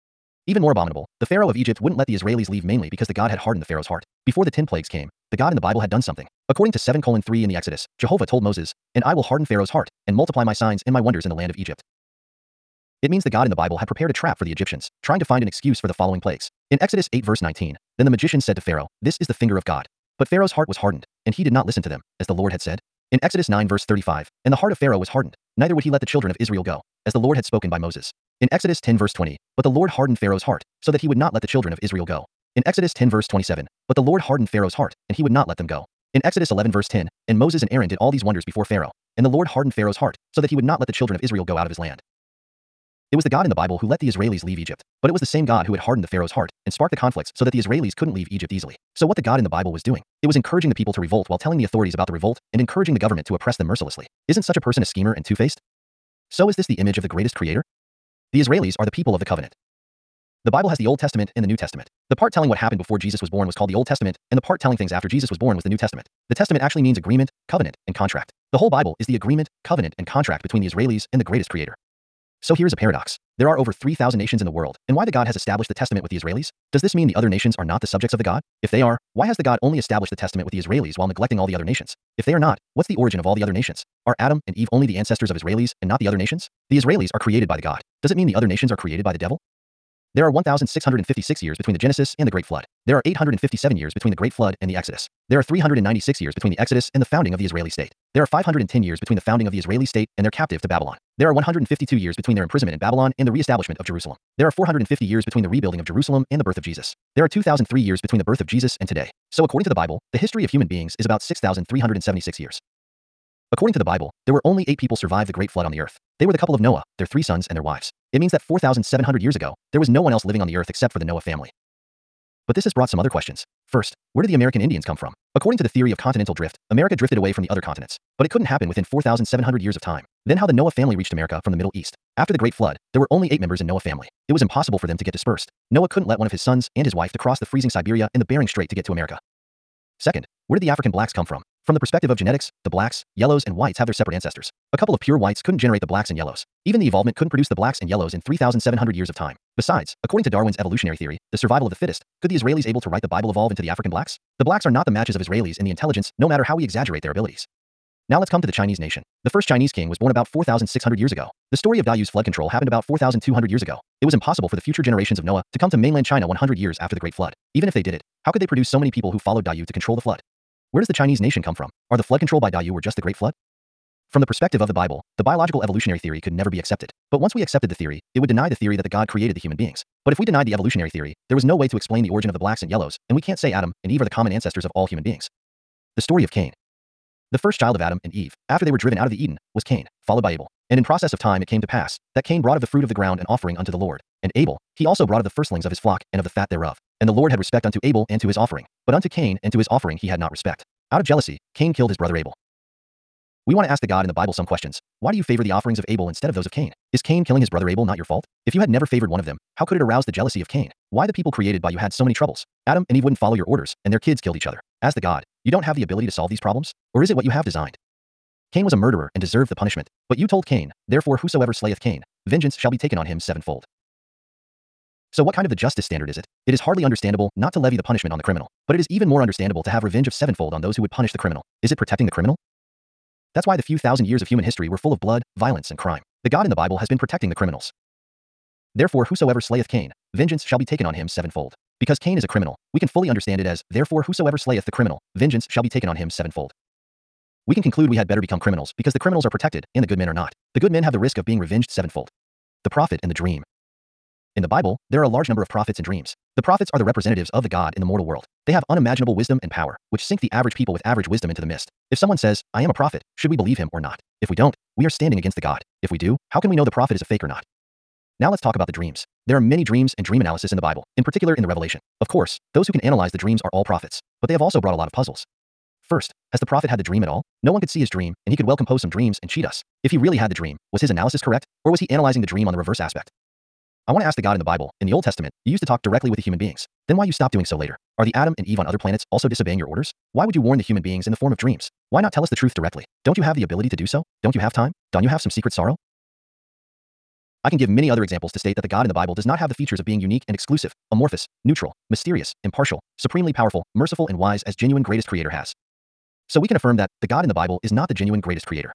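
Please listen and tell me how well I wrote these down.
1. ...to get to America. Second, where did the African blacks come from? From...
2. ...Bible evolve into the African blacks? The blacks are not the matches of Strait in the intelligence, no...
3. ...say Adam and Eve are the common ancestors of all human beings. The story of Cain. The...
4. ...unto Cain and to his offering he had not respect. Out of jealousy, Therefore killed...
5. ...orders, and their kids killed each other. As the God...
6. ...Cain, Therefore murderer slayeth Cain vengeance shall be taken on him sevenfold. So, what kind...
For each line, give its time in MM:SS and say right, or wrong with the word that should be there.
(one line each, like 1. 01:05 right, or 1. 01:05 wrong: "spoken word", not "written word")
1. 02:18 right
2. 02:33 wrong: "Israelis", not "Strait"
3. 03:03 right
4. 03:18 wrong: "Cain", not "Therefore"
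5. 03:33 right
6. 03:40 wrong: "whosoever", not "murderer".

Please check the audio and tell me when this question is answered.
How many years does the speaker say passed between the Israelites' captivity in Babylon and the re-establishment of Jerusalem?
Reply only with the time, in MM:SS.
01:41.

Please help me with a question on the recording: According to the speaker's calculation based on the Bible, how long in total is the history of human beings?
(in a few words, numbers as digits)
About 6,376 years.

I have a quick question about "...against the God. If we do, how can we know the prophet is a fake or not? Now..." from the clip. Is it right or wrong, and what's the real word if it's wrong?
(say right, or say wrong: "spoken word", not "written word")
right.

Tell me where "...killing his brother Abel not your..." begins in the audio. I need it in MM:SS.
03:27.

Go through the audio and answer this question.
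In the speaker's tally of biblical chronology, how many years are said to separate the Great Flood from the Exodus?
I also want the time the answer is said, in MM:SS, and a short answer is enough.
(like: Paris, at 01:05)
857, at 01:33.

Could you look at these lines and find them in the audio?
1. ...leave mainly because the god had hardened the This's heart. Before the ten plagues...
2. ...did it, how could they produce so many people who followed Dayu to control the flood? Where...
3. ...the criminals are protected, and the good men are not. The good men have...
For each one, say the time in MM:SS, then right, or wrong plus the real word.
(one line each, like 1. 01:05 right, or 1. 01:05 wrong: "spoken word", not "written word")
1. 00:02 wrong: "Pharaoh", not "This"
2. 02:47 right
3. 04:08 right.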